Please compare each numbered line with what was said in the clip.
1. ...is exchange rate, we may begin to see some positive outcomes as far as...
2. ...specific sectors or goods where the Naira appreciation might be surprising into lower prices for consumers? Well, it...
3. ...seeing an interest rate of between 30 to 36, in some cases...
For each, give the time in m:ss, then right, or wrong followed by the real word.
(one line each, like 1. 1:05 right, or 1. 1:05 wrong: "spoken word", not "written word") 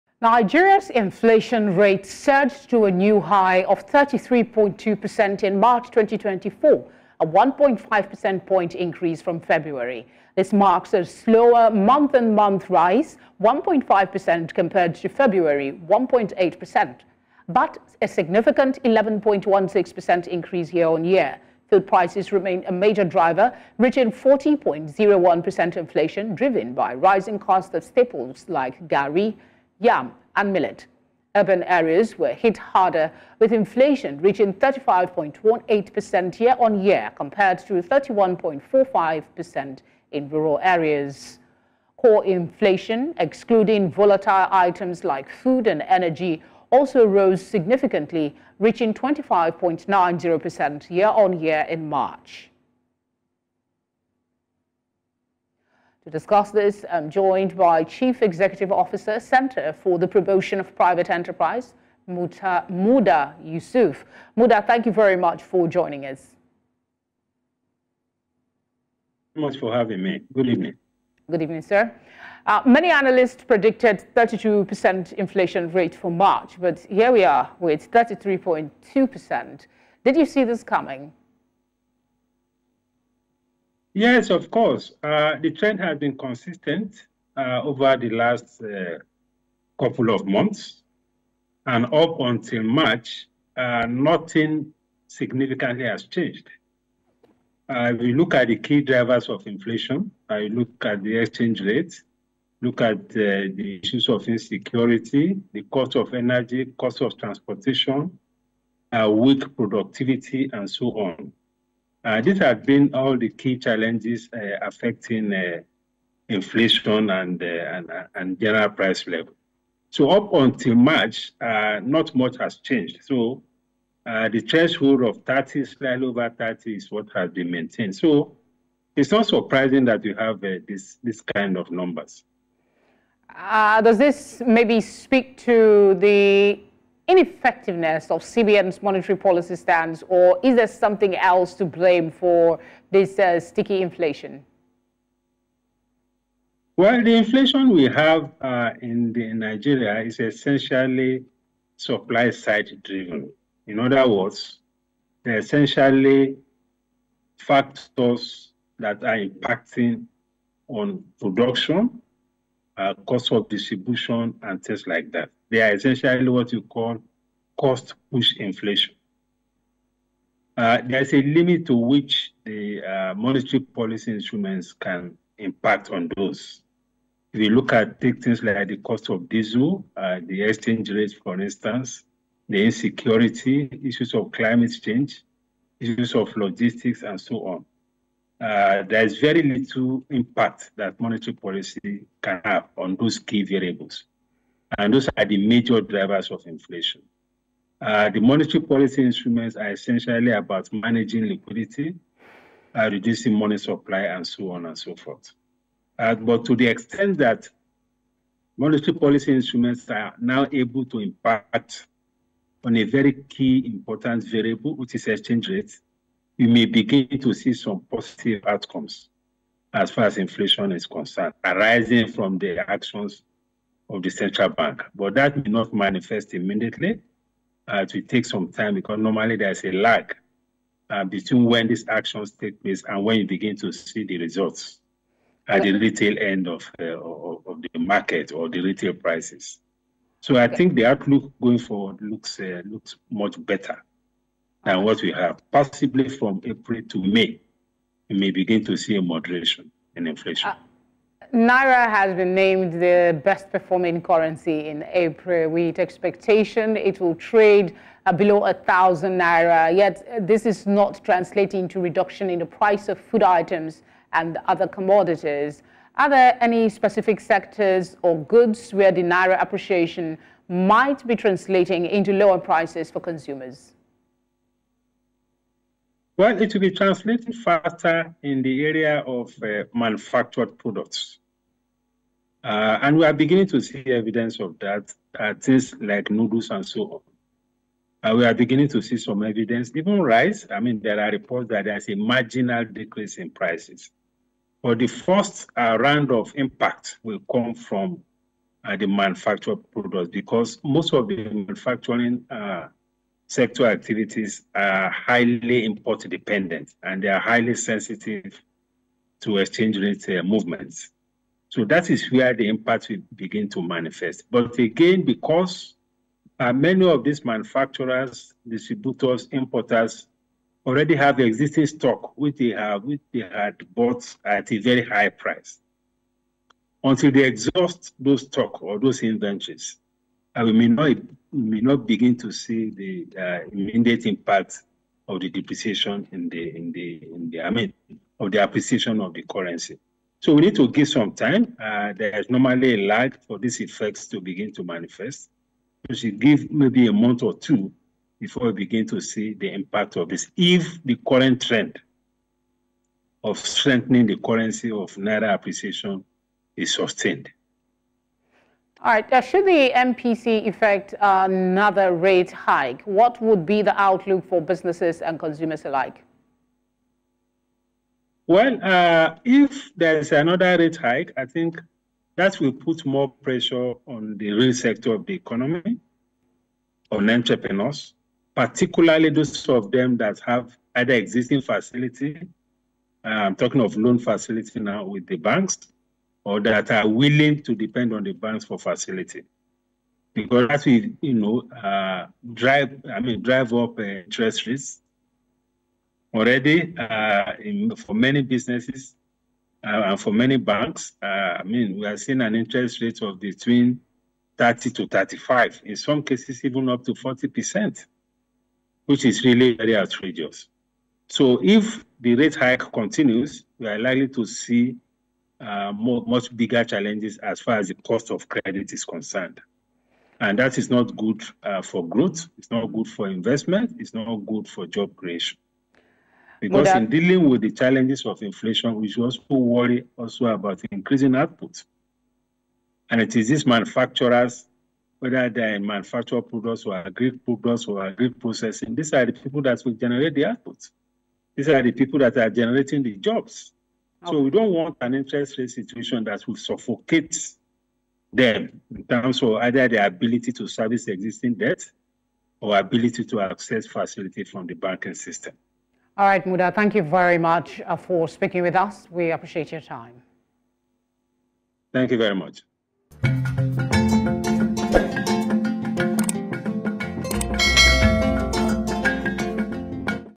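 1. 3:34 right
2. 4:26 wrong: "translating", not "surprising"
3. 6:41 wrong: "35", not "36".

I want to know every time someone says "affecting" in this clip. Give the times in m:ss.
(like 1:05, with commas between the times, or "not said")
1:54.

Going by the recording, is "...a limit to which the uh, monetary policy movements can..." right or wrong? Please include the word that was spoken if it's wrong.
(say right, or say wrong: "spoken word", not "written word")
wrong: "instruments", not "movements".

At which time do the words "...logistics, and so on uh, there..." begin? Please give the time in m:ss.
3:06.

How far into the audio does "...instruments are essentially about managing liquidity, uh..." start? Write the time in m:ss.
3:19.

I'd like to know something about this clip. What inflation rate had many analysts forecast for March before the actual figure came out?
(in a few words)
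32%.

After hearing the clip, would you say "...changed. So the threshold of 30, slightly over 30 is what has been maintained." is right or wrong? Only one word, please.
right.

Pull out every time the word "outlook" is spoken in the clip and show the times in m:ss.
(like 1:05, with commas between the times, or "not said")
4:00, 6:03.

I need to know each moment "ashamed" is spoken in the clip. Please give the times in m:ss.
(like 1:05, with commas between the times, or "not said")
not said.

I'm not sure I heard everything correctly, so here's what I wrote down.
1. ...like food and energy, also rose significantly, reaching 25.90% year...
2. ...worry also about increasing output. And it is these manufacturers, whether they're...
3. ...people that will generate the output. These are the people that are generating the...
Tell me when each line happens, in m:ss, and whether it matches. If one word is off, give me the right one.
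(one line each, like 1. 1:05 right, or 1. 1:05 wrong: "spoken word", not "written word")
1. 0:45 right
2. 7:09 right
3. 7:19 right.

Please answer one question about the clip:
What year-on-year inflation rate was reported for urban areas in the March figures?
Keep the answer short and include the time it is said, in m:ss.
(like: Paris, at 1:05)
35.18%, at 0:34.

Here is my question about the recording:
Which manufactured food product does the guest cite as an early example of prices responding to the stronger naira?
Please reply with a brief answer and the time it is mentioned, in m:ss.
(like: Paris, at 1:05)
noodles, at 4:46.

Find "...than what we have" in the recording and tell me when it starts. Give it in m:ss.
4:04.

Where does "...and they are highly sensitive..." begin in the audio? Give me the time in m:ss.
5:06.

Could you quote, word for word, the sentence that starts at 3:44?
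But that may not manifest immediately.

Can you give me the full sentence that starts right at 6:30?
Because as we you know, uh, drive, I mean, drive up uh, interest rates.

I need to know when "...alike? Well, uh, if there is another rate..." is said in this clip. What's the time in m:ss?
6:05.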